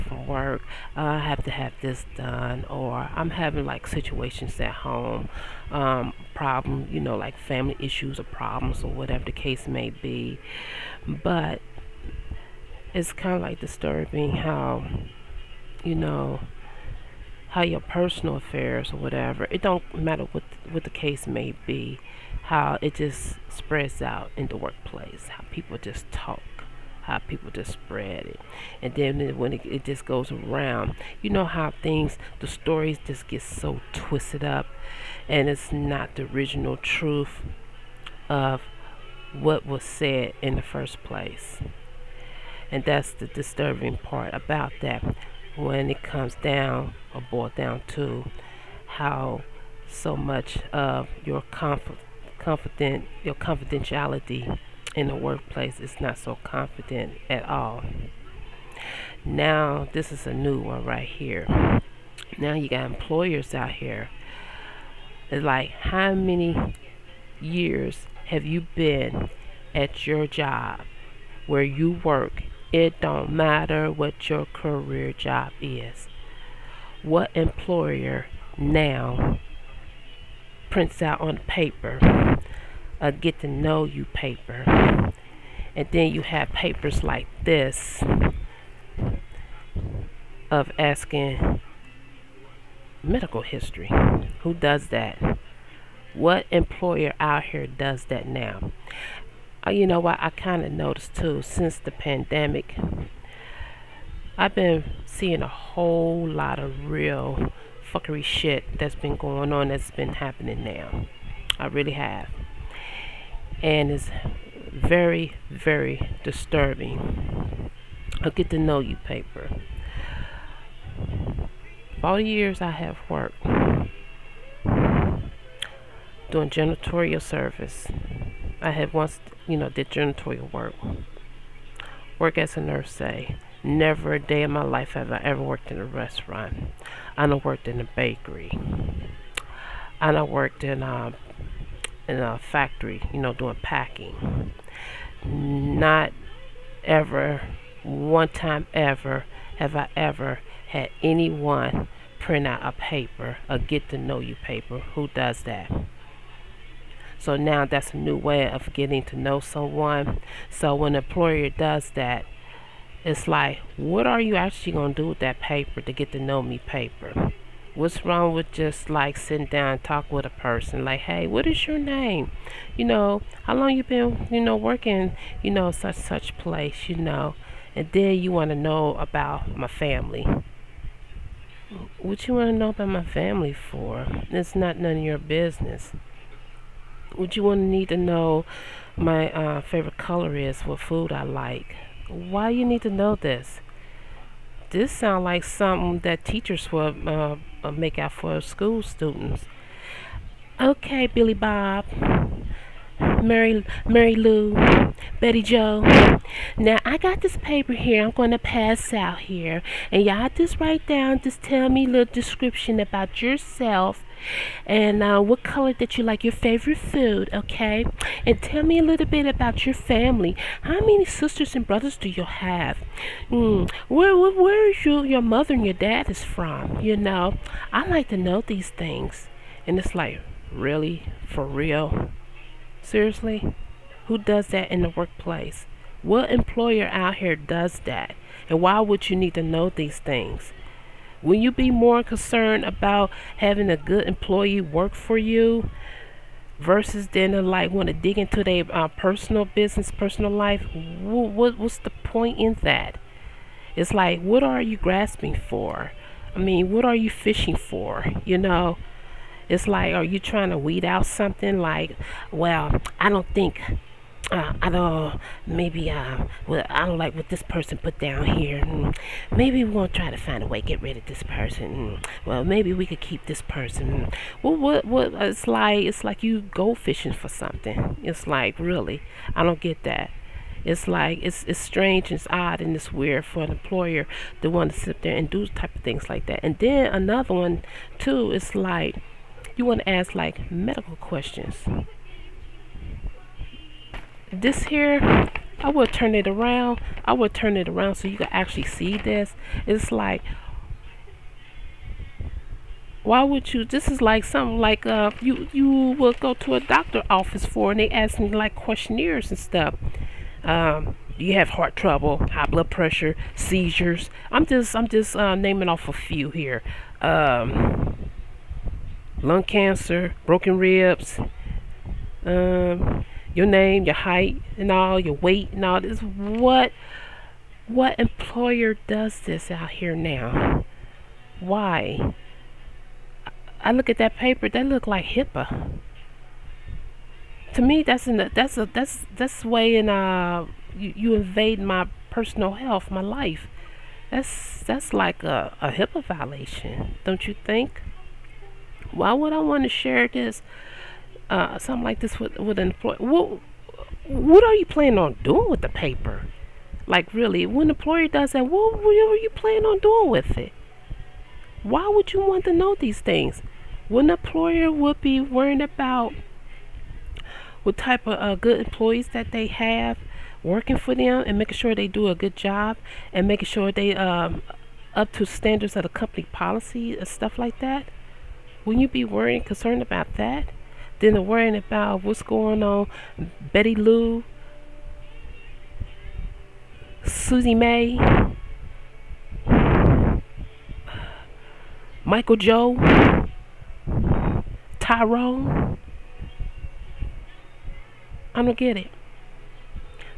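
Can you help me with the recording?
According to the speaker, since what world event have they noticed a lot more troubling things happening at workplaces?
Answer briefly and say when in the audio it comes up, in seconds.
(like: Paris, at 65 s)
the pandemic, at 101 s.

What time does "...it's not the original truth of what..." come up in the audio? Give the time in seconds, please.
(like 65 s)
35 s.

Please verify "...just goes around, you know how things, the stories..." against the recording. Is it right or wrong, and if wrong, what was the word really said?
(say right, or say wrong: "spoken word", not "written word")
right.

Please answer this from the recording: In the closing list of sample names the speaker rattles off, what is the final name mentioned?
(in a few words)
Tyrone.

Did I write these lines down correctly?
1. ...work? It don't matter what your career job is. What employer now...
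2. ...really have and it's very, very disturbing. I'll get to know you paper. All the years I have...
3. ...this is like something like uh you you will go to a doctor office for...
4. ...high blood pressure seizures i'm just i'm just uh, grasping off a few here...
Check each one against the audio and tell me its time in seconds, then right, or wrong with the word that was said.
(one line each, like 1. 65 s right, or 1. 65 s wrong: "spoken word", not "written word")
1. 72 s right
2. 111 s right
3. 303 s right
4. 312 s wrong: "naming", not "grasping".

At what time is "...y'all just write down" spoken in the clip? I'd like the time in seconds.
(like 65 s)
210 s.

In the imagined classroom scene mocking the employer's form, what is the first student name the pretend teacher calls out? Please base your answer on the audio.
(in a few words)
Billy Bob.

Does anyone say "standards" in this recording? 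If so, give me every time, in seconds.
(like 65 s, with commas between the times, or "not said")
375 s.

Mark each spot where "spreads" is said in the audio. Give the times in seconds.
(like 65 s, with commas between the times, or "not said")
23 s, 27 s.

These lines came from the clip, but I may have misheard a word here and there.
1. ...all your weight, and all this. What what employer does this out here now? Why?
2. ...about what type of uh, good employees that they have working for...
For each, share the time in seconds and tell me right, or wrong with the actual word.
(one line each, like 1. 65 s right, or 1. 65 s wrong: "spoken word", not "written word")
1. 324 s right
2. 365 s right.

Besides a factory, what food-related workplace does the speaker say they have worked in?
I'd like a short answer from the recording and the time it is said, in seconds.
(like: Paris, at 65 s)
bakery, at 137 s.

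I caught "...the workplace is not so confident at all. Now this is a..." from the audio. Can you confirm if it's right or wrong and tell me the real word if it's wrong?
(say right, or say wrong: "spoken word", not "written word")
right.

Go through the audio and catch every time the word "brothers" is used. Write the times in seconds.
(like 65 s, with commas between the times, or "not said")
221 s.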